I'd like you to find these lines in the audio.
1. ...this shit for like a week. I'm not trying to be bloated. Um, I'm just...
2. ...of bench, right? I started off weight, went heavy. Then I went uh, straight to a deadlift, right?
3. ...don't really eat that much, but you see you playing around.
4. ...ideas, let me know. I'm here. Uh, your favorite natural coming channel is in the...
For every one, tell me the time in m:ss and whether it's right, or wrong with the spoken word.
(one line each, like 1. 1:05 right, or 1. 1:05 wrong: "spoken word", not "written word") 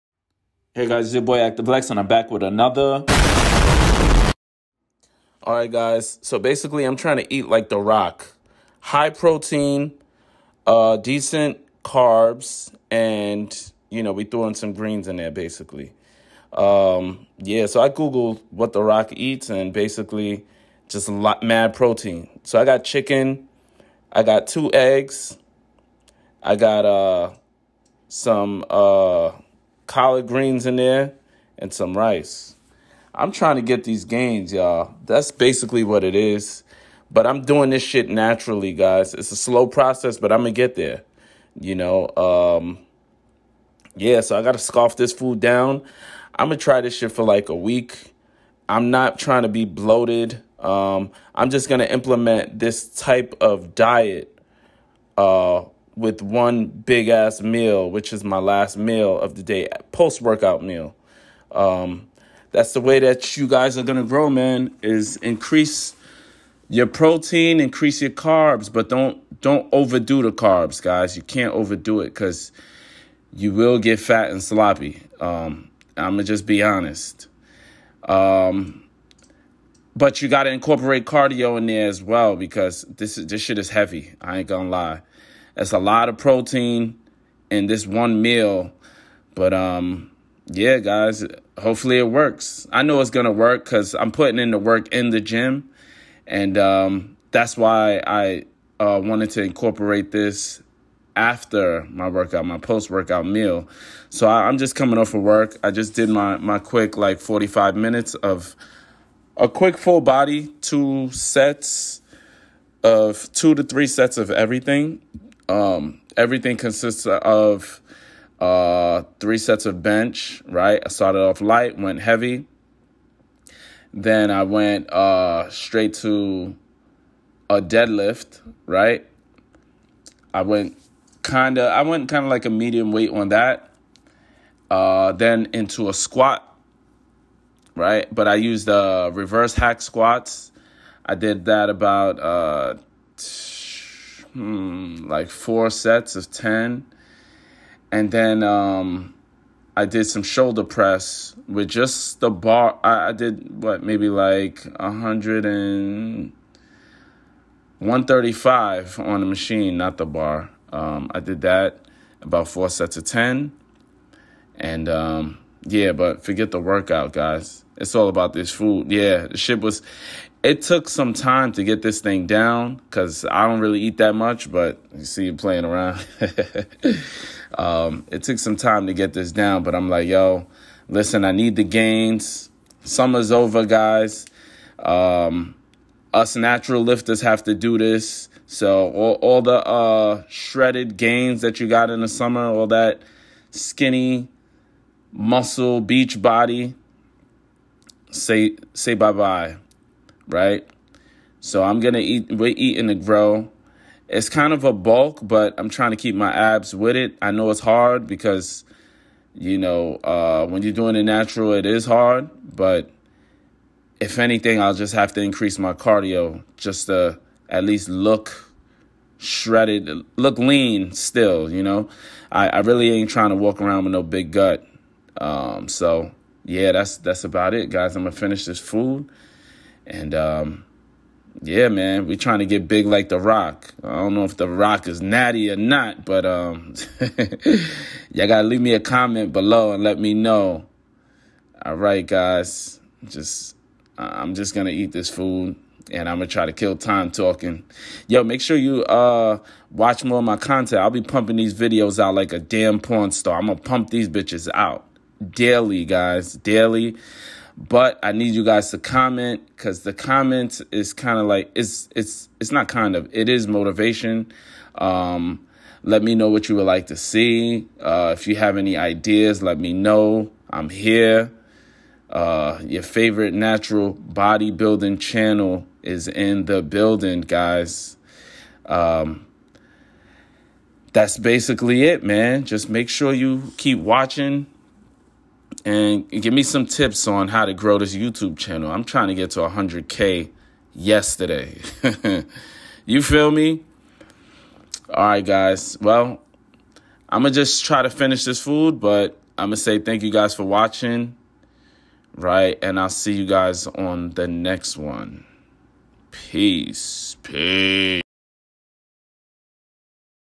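1. 0:46 right
2. 1:59 wrong: "light", not "weight"
3. 2:53 right
4. 4:28 wrong: "bodybuilding", not "coming".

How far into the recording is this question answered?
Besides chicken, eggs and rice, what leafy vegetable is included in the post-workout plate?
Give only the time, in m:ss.
0:29.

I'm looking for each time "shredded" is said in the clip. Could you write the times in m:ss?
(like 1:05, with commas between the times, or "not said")
3:10, 3:39.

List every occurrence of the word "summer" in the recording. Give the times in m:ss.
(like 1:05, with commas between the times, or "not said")
3:02, 3:12.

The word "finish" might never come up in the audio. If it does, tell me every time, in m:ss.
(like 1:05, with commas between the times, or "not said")
3:48, 4:57.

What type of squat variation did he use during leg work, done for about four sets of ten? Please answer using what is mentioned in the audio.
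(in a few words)
Reverse hack squats.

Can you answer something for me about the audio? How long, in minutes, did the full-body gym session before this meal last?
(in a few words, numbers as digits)
45.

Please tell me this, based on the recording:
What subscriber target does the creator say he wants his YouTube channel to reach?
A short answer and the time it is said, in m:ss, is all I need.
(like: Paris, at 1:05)
100K, at 4:49.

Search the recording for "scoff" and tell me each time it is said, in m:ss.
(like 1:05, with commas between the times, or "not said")
0:44.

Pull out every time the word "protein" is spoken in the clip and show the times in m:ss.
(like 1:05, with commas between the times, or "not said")
0:09, 0:21, 1:06, 1:26.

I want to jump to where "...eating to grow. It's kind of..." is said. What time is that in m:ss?
3:22.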